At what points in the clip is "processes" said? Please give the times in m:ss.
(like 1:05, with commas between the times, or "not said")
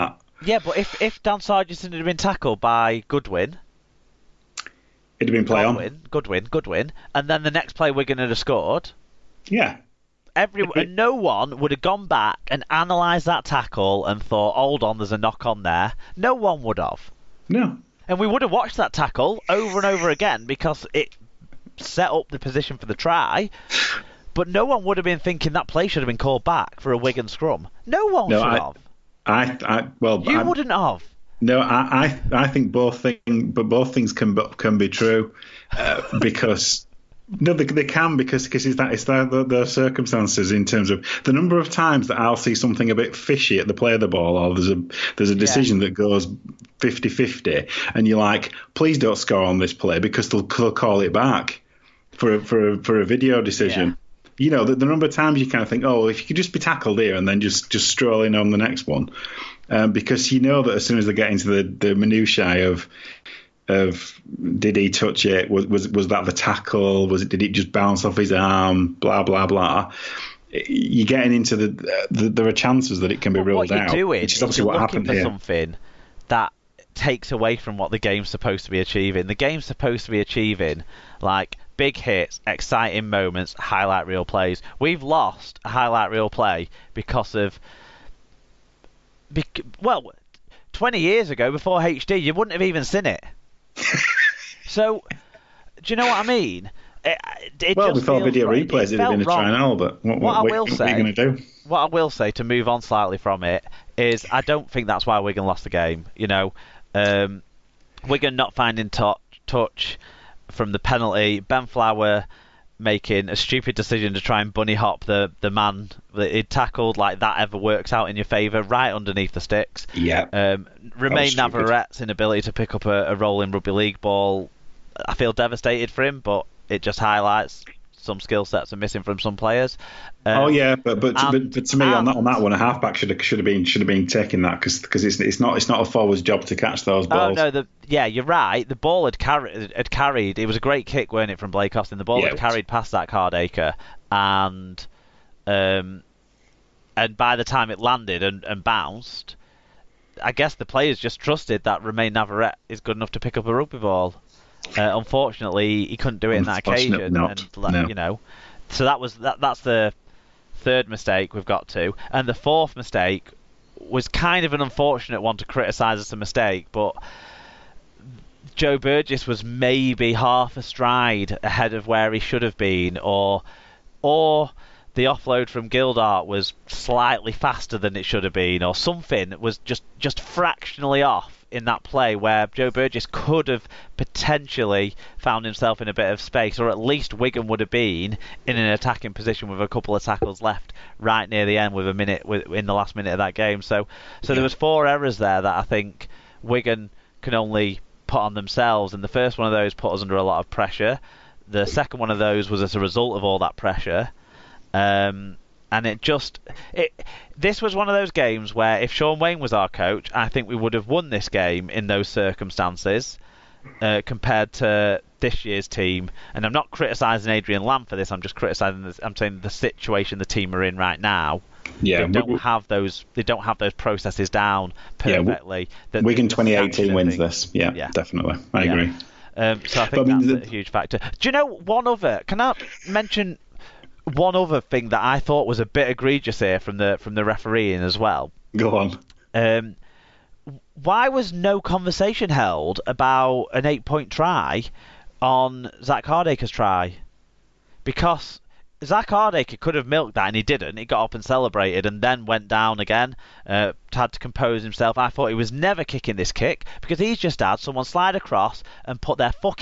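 3:43.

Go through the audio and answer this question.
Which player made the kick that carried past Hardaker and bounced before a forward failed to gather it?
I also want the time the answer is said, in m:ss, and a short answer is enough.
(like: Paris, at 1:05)
Blake Austin, at 2:21.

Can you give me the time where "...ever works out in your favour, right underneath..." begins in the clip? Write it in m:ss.
1:57.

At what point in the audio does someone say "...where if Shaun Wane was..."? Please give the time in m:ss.
3:28.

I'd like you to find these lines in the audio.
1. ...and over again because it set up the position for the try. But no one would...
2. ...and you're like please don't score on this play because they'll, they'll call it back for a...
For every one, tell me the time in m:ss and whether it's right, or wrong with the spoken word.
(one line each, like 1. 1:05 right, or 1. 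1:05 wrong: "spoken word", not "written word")
1. 0:19 right
2. 0:47 right.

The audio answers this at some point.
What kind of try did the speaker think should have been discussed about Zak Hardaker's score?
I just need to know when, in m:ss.
4:03.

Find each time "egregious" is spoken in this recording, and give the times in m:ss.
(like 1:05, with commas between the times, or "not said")
3:55.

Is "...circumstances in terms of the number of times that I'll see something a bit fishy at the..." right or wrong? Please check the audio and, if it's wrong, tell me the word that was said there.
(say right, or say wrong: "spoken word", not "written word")
right.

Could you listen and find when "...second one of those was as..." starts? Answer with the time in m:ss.
3:21.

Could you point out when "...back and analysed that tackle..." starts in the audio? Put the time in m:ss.
0:12.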